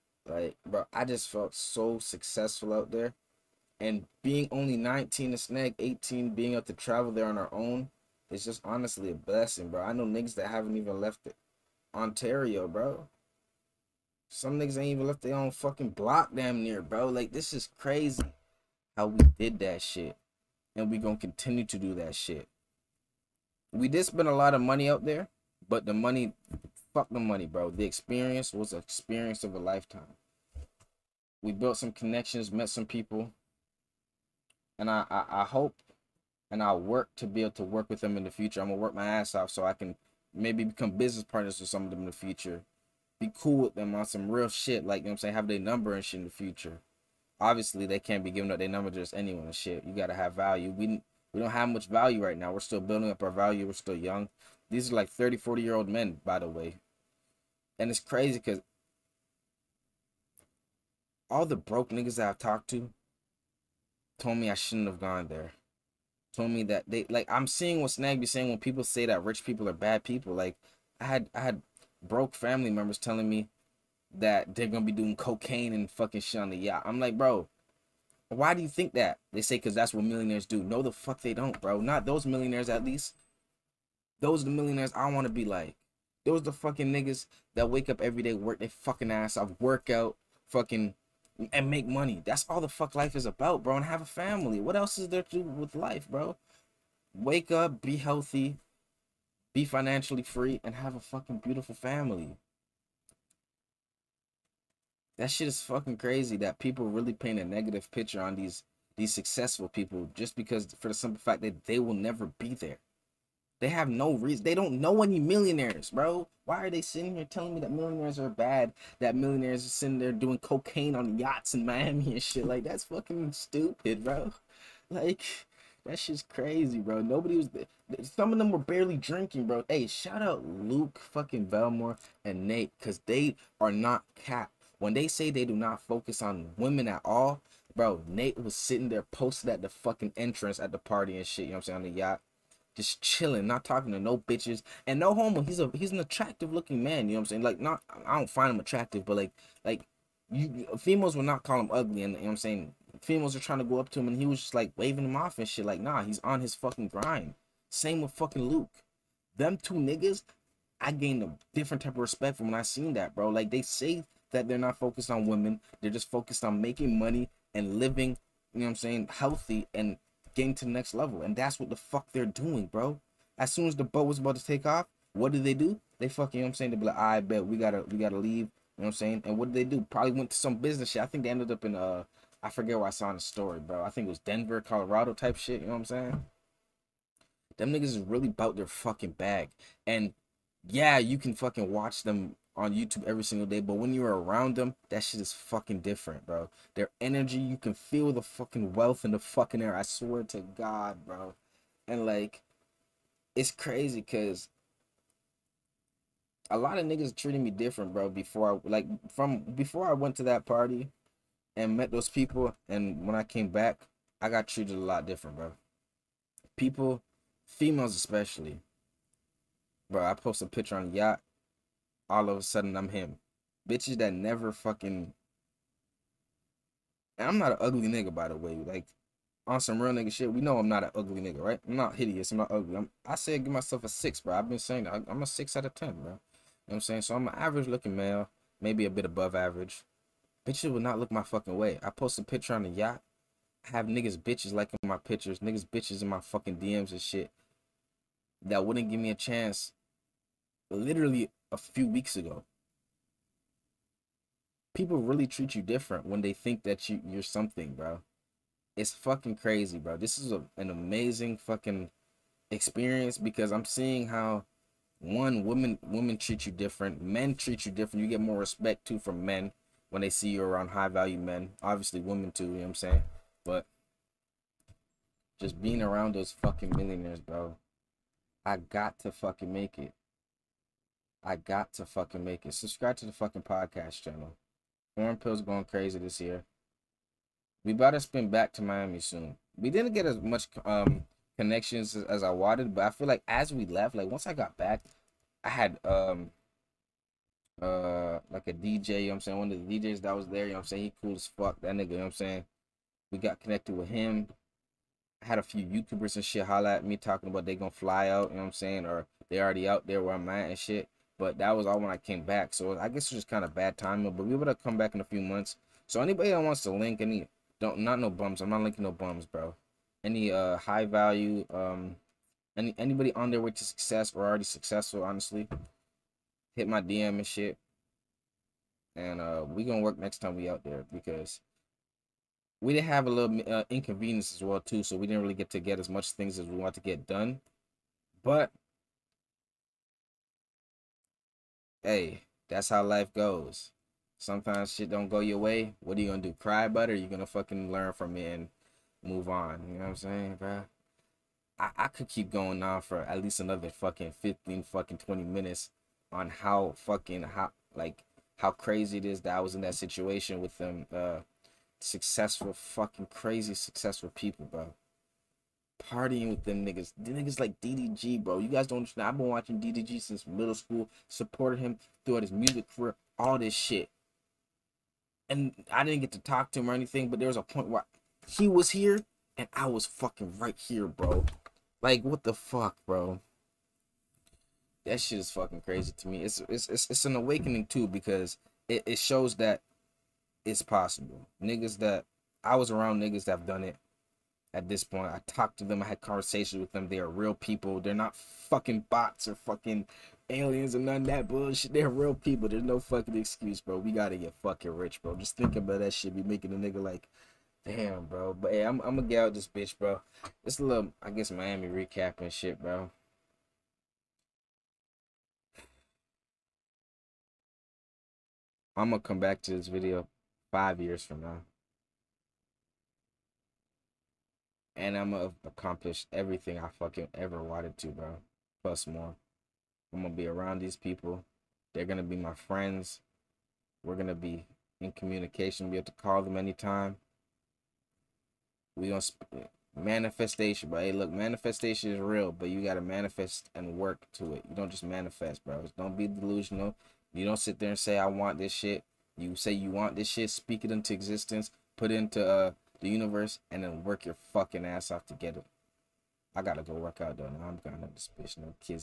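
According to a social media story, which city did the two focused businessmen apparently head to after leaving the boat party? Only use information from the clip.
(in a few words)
Denver, Colorado.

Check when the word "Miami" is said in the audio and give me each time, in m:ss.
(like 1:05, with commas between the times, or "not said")
2:01, 4:48, 6:51.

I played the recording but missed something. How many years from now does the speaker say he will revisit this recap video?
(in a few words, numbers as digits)
5 years.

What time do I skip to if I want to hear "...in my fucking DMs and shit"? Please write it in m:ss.
4:06.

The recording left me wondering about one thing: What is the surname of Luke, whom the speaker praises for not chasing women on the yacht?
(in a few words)
Belmar.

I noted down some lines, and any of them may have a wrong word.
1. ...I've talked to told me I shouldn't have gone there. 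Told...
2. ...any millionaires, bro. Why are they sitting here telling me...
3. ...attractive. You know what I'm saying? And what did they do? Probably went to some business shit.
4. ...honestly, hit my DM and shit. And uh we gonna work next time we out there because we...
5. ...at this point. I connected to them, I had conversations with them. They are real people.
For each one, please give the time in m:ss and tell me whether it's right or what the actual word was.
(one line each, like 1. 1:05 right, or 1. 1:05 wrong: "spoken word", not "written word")
1. 1:02 right
2. 1:55 right
3. 2:58 wrong: "leave", not "attractive"
4. 5:25 right
5. 6:34 wrong: "talked", not "connected".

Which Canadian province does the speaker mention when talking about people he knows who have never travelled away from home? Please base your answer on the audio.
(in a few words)
Ontario.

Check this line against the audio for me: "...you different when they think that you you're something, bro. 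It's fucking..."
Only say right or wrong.
right.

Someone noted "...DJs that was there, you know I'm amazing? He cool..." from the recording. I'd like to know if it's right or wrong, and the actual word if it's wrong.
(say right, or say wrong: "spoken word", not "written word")
wrong: "saying", not "amazing".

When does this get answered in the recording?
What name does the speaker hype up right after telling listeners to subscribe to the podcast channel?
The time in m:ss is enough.
4:44.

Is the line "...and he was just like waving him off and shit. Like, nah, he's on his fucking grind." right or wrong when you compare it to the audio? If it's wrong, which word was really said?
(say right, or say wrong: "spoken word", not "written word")
right.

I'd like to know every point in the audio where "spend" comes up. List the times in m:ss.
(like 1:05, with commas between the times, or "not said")
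0:24.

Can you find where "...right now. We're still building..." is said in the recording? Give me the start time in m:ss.
0:52.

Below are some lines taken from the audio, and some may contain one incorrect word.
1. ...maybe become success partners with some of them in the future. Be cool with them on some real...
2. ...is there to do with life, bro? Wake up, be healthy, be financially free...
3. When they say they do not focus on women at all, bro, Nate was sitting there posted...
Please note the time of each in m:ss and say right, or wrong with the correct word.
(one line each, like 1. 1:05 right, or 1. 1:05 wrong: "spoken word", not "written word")
1. 0:40 wrong: "business", not "success"
2. 1:34 right
3. 2:14 right.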